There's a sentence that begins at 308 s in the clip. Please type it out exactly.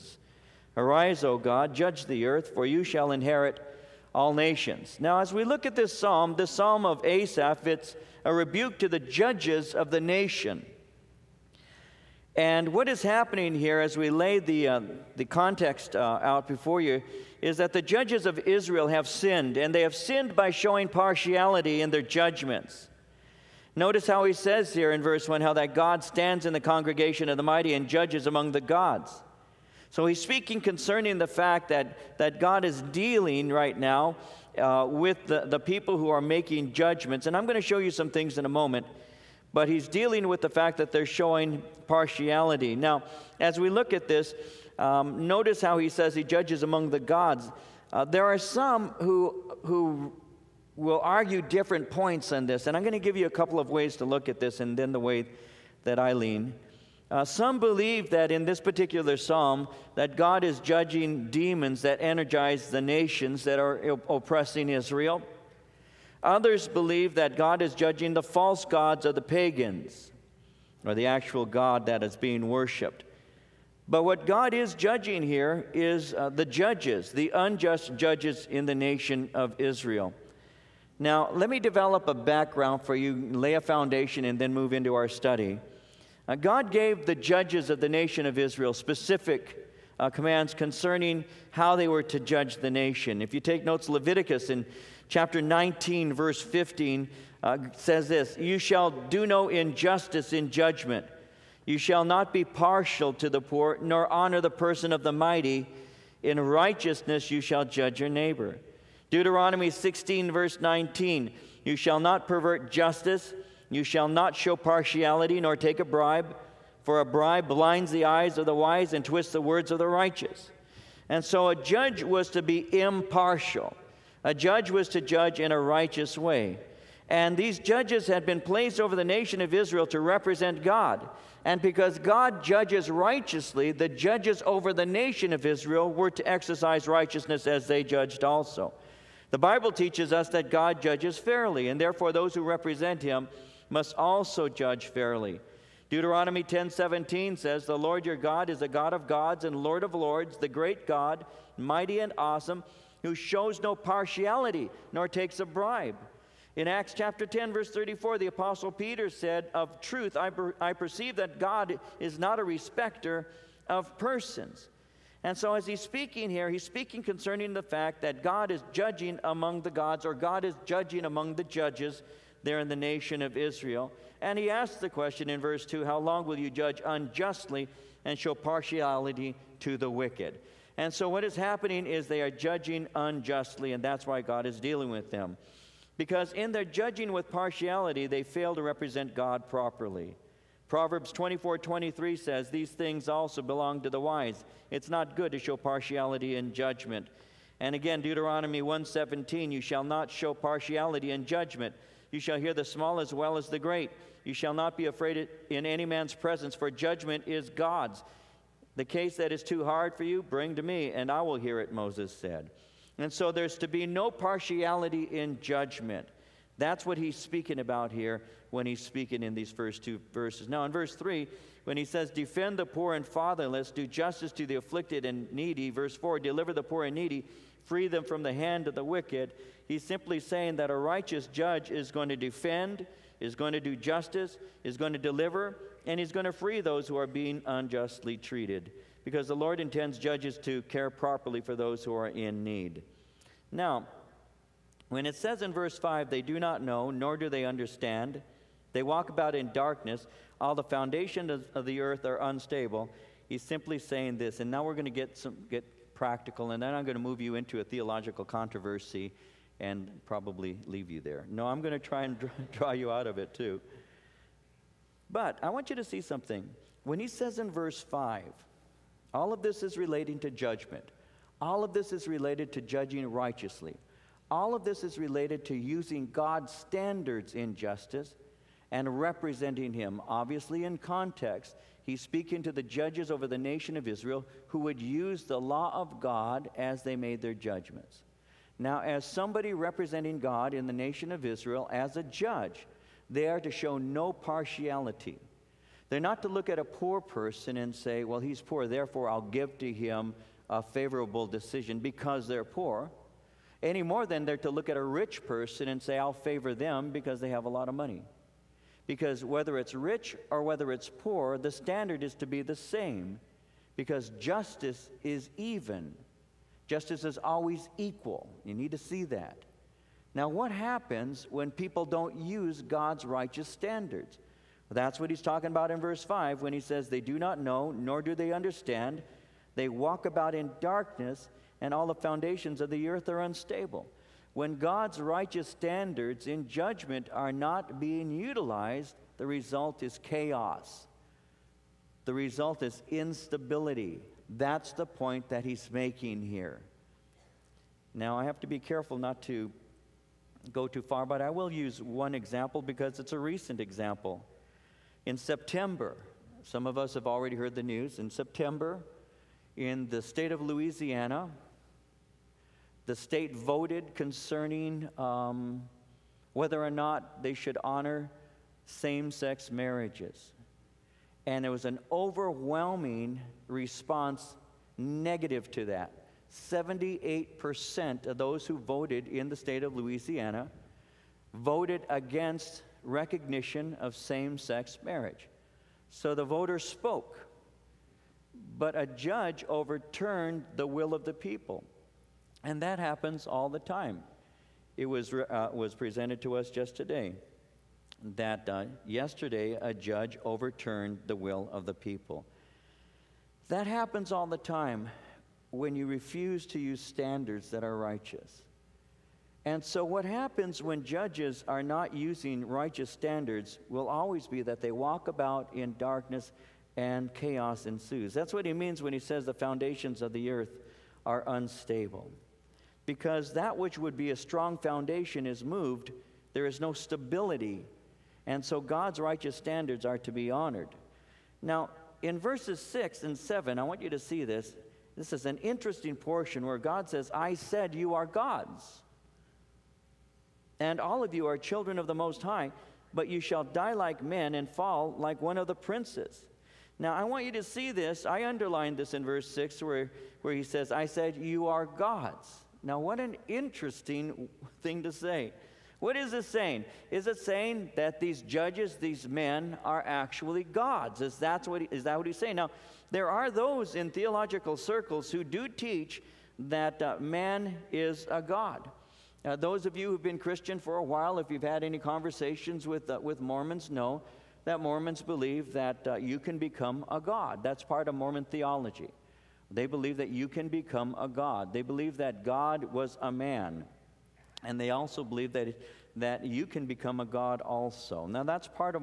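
Because whether it's rich or whether it's poor, the standard is to be the same.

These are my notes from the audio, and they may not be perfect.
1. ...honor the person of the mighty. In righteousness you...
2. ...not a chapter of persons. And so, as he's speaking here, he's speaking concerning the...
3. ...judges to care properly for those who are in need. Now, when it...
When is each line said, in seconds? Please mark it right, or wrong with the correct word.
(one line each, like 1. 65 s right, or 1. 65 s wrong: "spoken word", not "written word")
1. 104 s right
2. 162 s wrong: "respecter", not "chapter"
3. 239 s right.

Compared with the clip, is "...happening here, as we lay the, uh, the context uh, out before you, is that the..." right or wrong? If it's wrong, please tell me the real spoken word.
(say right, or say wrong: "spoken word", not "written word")
right.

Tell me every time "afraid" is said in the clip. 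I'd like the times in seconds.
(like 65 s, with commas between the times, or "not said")
204 s.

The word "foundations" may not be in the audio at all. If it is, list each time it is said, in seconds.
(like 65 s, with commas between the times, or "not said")
83 s, 250 s, 331 s, 419 s, 424 s.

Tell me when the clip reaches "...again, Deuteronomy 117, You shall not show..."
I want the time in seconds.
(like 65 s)
197 s.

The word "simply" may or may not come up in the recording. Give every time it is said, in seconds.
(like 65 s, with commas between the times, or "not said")
229 s, 253 s.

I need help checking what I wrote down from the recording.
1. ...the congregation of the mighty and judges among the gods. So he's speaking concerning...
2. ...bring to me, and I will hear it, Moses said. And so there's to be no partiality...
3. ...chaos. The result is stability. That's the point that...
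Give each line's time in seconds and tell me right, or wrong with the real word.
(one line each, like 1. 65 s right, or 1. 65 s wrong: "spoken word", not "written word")
1. 26 s right
2. 210 s right
3. 339 s wrong: "instability", not "stability".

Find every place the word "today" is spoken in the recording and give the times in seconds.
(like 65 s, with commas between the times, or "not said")
396 s.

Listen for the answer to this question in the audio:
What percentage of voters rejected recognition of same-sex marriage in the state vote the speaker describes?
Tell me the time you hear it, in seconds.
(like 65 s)
376 s.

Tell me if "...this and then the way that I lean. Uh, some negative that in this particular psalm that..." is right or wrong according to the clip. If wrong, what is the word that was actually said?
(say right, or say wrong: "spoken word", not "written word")
wrong: "believe", not "negative".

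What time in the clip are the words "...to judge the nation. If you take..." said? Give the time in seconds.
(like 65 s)
92 s.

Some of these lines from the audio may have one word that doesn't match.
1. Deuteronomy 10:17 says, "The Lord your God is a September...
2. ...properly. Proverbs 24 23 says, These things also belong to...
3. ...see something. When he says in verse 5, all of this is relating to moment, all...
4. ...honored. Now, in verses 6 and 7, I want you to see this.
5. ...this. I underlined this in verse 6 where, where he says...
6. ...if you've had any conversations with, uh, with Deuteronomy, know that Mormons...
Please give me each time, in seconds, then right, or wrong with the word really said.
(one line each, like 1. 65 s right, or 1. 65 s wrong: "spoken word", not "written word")
1. 145 s wrong: "God", not "September"
2. 189 s right
3. 265 s wrong: "judgment", not "moment"
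4. 430 s right
5. 447 s right
6. 471 s wrong: "Mormons", not "Deuteronomy".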